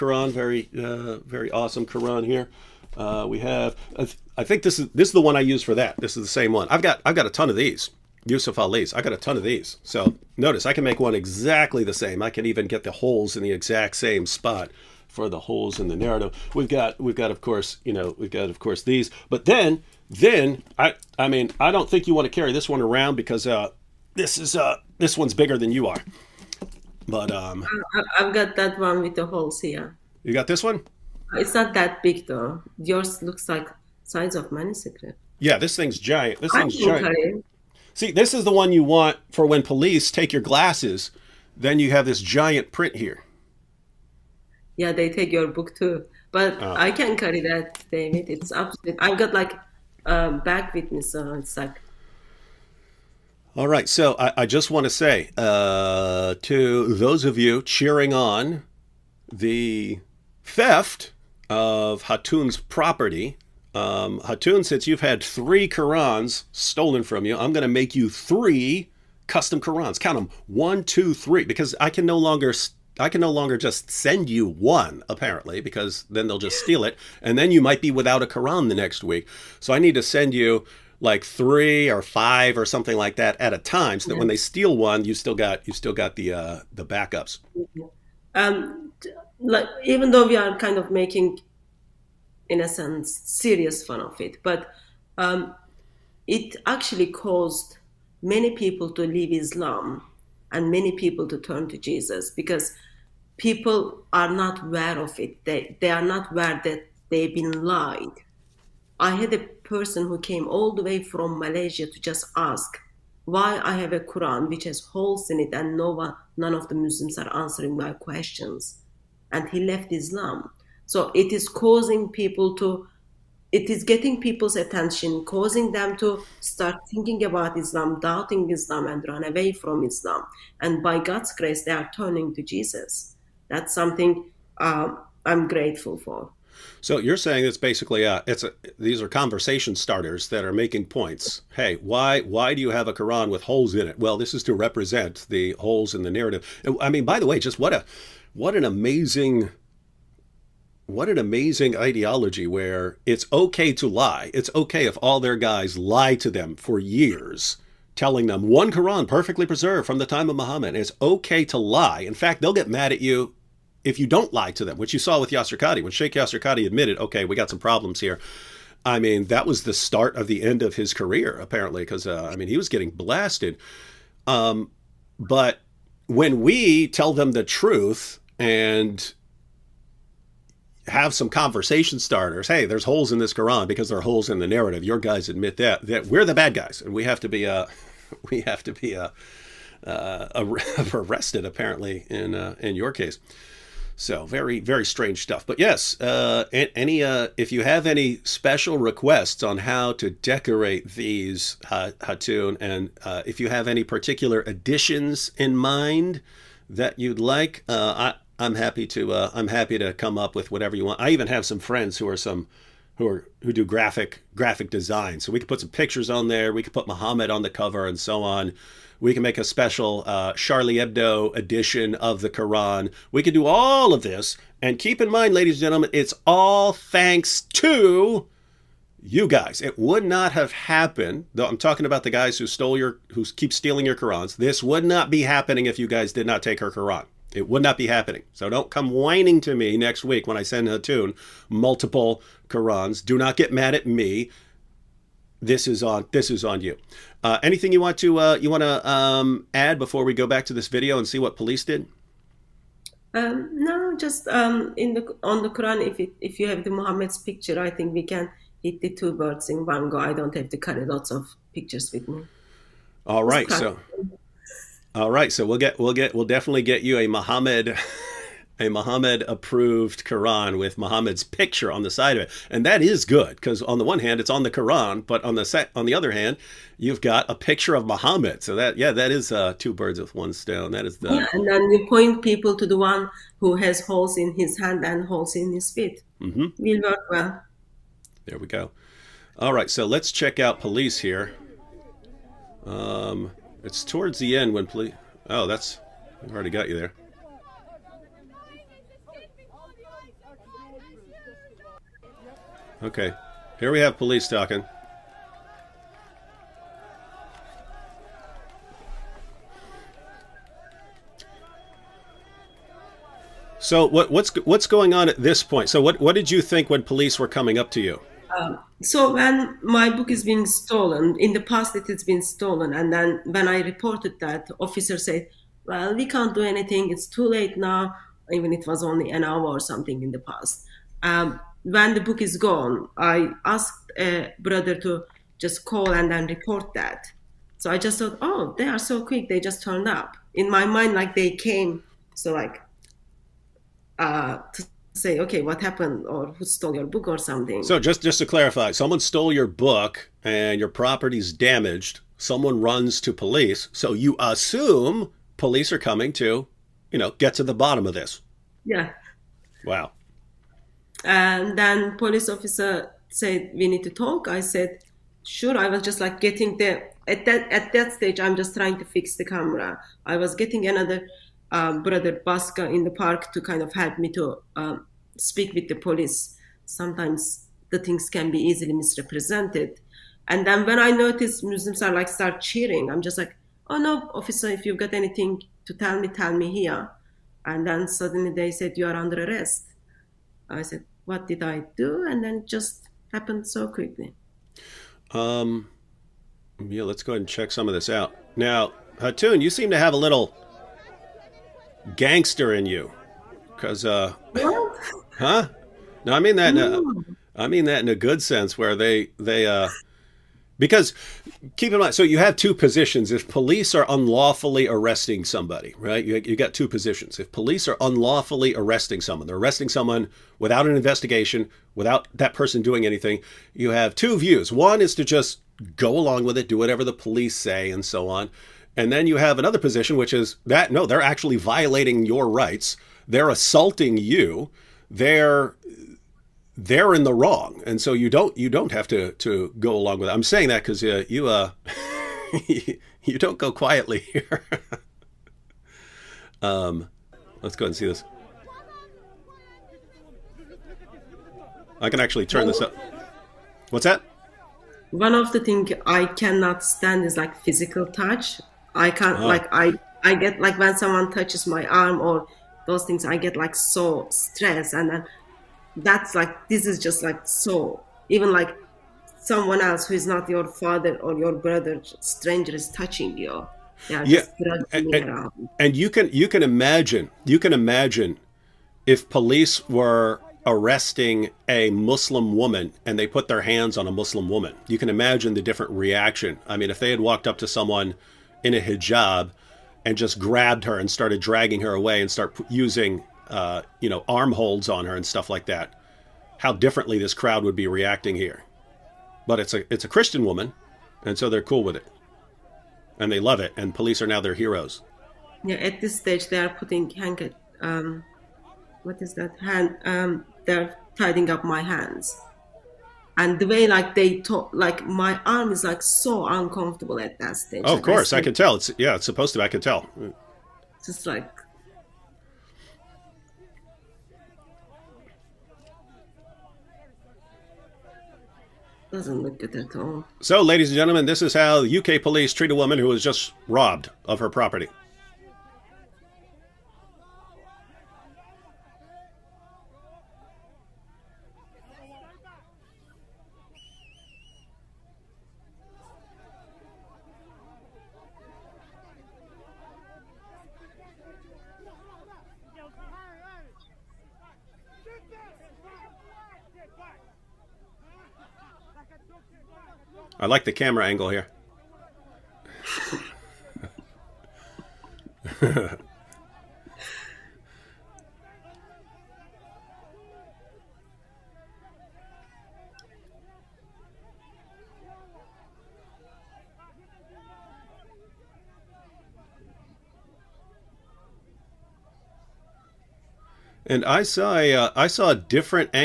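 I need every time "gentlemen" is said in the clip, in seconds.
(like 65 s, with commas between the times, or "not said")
225 s, 530 s.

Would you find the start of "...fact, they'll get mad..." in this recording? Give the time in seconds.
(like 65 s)
162 s.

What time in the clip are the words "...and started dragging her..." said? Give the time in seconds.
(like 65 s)
490 s.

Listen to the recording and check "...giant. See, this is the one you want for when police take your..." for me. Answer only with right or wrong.
right.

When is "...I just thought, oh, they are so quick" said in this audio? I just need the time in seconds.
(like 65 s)
337 s.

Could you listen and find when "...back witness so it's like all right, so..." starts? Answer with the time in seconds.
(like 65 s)
50 s.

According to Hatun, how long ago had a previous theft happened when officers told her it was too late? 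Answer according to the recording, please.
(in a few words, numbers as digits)
an hour.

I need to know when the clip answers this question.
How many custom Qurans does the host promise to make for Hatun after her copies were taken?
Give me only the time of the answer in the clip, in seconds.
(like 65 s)
68 s.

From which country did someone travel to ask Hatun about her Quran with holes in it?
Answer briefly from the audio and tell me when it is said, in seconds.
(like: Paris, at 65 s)
Malaysia, at 111 s.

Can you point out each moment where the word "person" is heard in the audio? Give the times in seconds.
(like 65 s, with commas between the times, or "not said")
109 s, 422 s.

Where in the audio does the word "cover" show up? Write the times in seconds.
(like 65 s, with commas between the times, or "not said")
217 s.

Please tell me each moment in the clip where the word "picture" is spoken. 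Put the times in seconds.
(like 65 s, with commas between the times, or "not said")
215 s, 257 s, 261 s, 271 s, 277 s.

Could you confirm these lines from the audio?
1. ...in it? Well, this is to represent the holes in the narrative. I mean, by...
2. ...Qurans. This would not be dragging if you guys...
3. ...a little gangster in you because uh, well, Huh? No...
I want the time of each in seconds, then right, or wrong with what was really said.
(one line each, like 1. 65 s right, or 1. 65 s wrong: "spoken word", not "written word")
1. 143 s right
2. 233 s wrong: "happening", not "dragging"
3. 399 s right.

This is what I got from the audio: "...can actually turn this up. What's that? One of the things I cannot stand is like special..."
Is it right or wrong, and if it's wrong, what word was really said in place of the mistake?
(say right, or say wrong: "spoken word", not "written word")
wrong: "physical", not "special".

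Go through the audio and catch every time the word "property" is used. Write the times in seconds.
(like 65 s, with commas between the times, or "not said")
62 s, 350 s, 534 s.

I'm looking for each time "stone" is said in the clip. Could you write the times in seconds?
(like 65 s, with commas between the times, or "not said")
280 s.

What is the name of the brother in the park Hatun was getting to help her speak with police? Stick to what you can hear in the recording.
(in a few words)
Baska.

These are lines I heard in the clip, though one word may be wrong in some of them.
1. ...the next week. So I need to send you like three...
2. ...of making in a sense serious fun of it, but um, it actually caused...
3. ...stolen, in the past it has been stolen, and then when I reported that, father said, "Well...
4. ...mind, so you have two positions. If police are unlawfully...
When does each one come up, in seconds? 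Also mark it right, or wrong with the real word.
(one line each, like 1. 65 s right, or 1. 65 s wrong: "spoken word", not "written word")
1. 78 s right
2. 90 s right
3. 320 s wrong: "officer", not "father"
4. 411 s right.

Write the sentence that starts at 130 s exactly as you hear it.
And by God's grace, they are turning to Jesus that's something um, I'm grateful for.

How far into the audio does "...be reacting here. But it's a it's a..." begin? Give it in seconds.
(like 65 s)
497 s.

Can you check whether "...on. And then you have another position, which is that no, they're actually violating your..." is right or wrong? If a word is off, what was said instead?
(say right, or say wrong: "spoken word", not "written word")
right.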